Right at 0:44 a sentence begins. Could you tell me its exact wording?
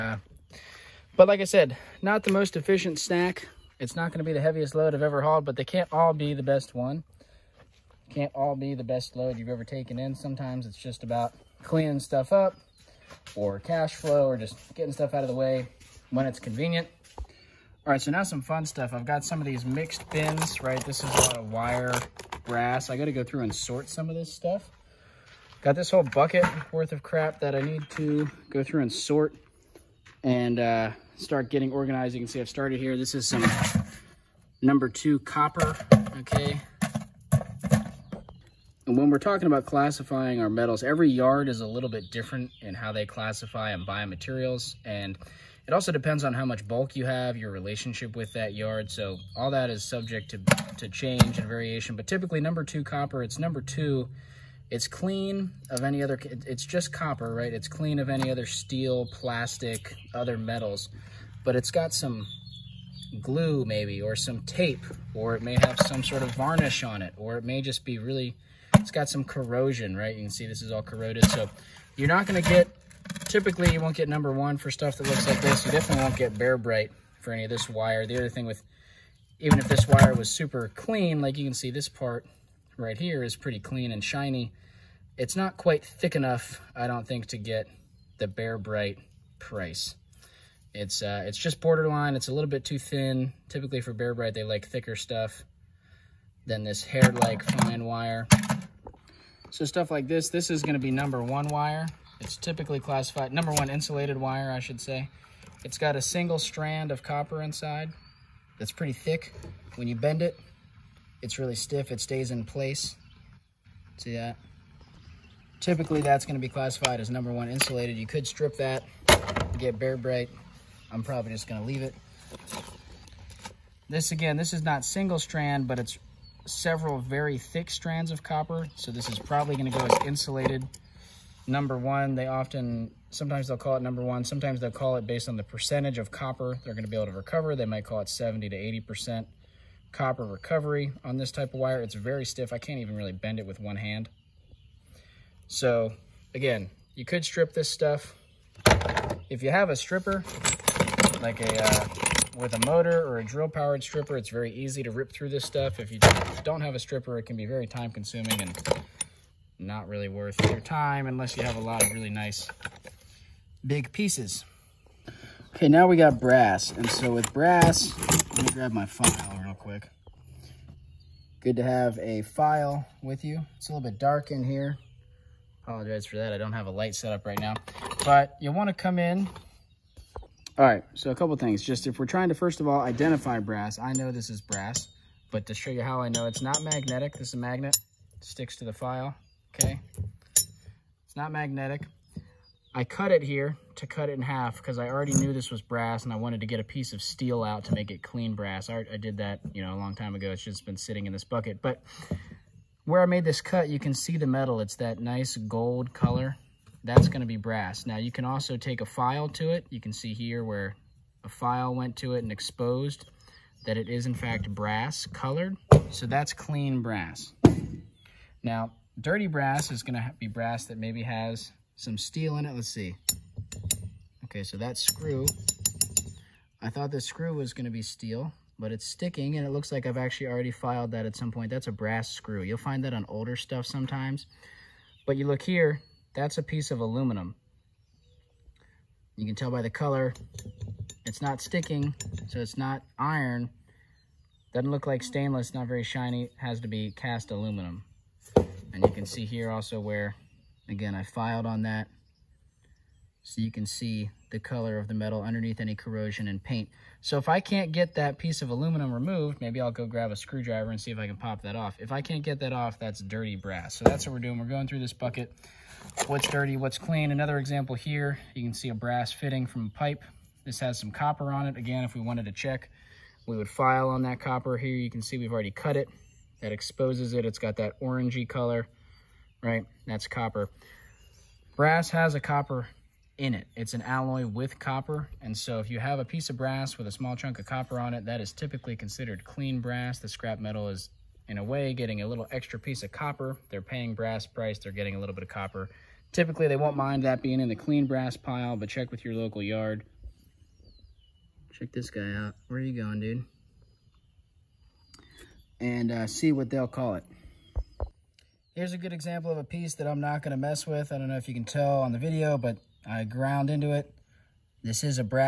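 And it also depends on how much bulk you have, your relationship with that yard.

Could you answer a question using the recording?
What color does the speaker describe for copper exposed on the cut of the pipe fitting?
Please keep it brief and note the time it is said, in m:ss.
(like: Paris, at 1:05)
orangey, at 4:37.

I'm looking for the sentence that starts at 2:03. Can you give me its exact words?
This, again, this is not single strand, but it's several very thick strands of copper.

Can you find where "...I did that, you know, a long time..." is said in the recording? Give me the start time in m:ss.
3:18.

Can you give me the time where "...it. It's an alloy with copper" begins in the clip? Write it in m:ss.
4:43.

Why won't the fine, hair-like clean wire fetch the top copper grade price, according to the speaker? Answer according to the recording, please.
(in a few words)
too thin.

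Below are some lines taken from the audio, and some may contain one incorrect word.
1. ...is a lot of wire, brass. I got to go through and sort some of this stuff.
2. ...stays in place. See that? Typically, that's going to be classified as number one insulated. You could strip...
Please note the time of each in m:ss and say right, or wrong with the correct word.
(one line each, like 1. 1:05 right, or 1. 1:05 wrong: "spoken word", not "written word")
1. 0:21 right
2. 1:51 right.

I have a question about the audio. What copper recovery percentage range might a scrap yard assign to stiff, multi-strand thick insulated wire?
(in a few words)
70 to 80%.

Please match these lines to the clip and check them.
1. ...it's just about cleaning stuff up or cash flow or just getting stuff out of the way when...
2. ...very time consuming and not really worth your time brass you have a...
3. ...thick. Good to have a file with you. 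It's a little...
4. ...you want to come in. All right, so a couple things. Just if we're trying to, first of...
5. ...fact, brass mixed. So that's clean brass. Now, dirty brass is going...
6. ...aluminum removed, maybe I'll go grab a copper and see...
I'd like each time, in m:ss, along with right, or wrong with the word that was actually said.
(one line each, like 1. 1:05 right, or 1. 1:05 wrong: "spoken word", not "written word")
1. 0:10 right
2. 2:37 wrong: "unless", not "brass"
3. 2:49 wrong: "quick", not "thick"
4. 2:58 right
5. 3:34 wrong: "colored", not "mixed"
6. 4:18 wrong: "screwdriver", not "copper".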